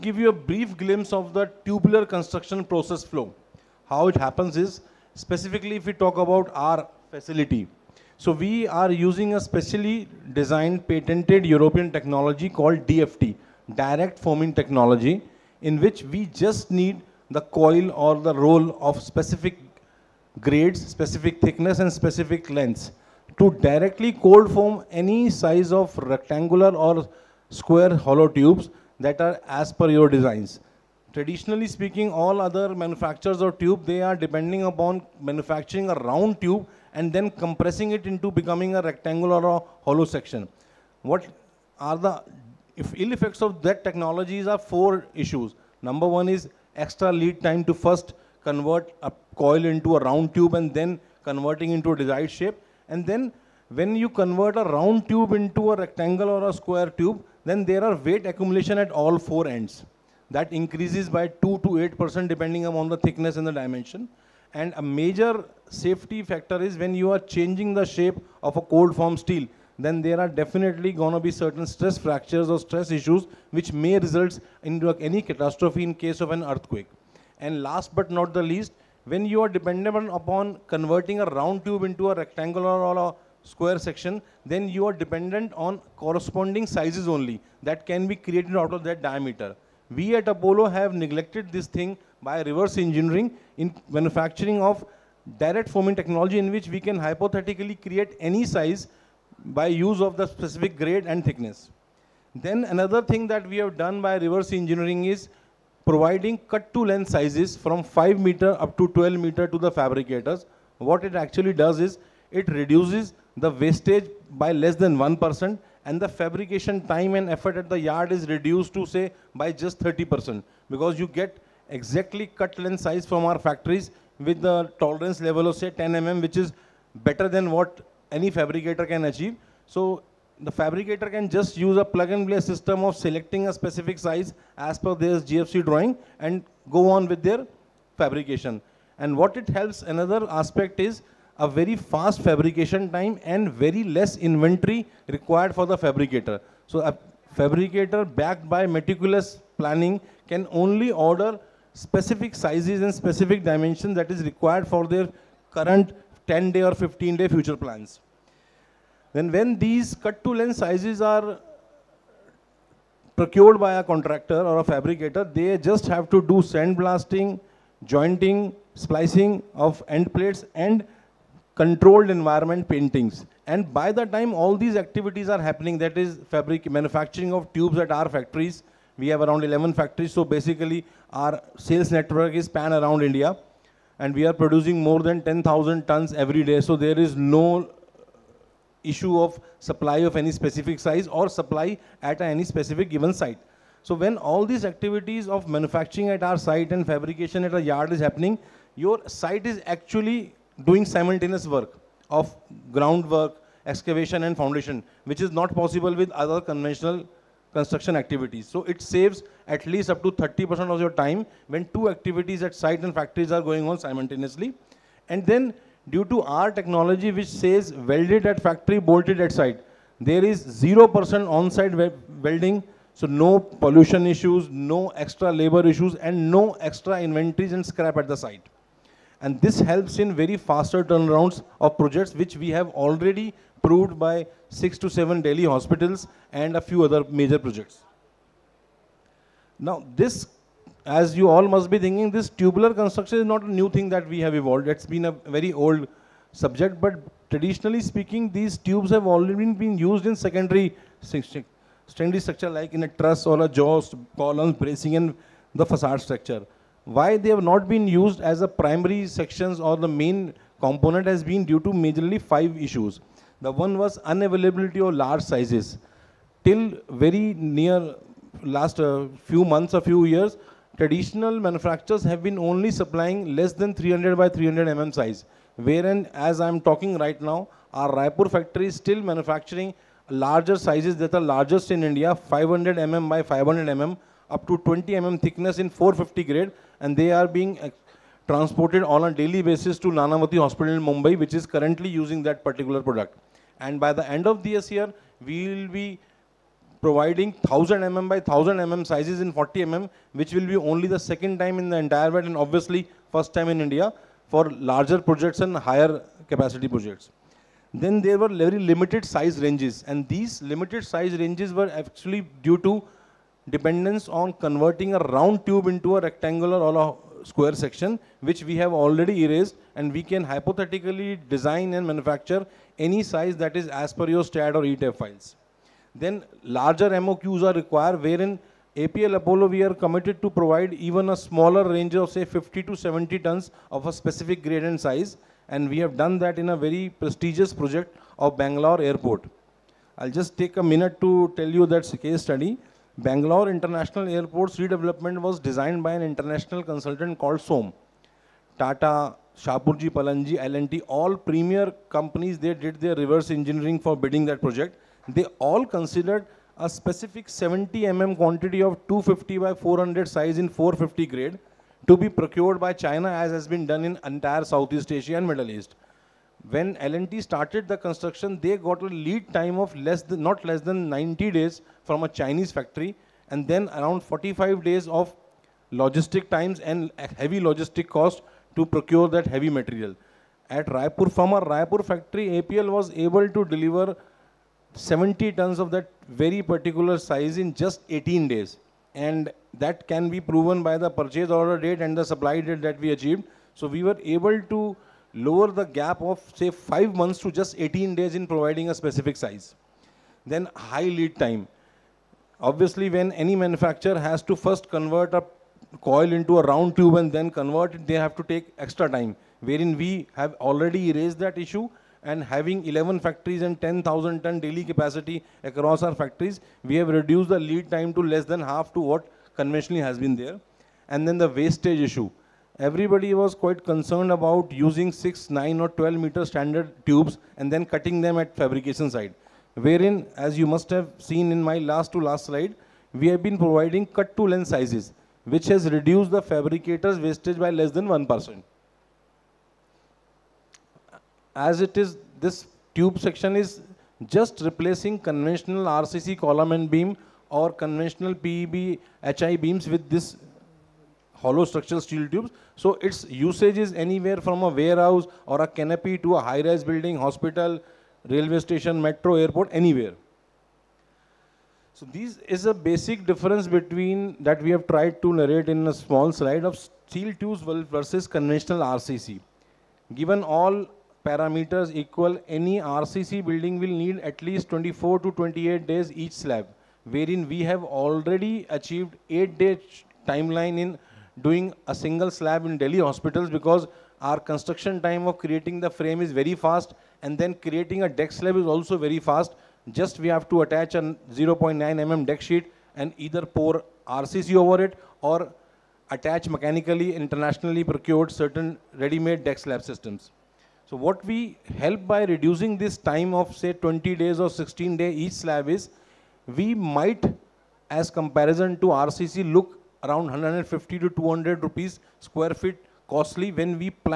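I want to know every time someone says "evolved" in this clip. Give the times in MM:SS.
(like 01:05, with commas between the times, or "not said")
04:04.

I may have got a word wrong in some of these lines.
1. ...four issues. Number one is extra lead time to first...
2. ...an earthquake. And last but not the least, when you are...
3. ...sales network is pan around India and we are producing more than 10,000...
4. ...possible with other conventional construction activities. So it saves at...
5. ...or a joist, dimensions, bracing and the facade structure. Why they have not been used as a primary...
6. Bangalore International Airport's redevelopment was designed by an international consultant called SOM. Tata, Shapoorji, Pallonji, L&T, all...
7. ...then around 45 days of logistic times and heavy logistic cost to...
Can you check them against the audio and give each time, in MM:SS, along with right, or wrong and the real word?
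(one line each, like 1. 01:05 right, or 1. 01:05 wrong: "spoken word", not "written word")
1. 00:44 right
2. 01:16 right
3. 03:01 right
4. 03:25 right
5. 04:13 wrong: "columns", not "dimensions"
6. 05:42 right
7. 06:13 right.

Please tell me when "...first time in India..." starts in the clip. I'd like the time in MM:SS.
05:03.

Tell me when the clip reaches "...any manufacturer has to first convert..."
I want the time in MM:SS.
06:43.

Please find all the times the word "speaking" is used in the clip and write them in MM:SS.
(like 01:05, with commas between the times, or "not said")
00:31, 04:07.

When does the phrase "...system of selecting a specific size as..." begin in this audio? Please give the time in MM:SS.
02:12.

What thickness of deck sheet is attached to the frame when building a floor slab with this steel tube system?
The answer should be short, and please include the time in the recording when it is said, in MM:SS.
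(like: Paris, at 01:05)
0.9 mm, at 08:10.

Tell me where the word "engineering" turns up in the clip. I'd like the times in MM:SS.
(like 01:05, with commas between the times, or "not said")
01:32, 01:44, 05:53.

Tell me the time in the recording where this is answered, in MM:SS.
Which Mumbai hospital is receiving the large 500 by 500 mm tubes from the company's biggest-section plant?
04:49.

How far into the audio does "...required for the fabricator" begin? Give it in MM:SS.
02:25.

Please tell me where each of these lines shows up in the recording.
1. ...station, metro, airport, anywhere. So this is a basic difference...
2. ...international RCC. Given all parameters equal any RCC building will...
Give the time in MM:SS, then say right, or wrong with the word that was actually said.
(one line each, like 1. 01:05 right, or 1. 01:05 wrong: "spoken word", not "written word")
1. 07:38 right
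2. 07:48 wrong: "conventional", not "international".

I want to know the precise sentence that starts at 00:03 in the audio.
How it happens is, specifically if we talk about our facility.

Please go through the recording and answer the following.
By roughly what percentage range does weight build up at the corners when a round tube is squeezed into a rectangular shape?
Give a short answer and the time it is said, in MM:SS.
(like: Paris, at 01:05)
2 to 8%, at 01:01.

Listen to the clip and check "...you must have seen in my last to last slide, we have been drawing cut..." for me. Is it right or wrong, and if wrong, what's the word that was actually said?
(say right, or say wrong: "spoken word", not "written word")
wrong: "providing", not "drawing".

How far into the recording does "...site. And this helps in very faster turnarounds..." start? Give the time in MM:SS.
03:48.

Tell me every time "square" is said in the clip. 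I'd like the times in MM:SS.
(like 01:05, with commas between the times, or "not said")
00:27, 00:56, 01:23, 05:17, 08:31.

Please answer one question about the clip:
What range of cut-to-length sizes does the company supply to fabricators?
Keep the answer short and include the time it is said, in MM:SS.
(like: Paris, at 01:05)
5 to 12 meters, at 01:47.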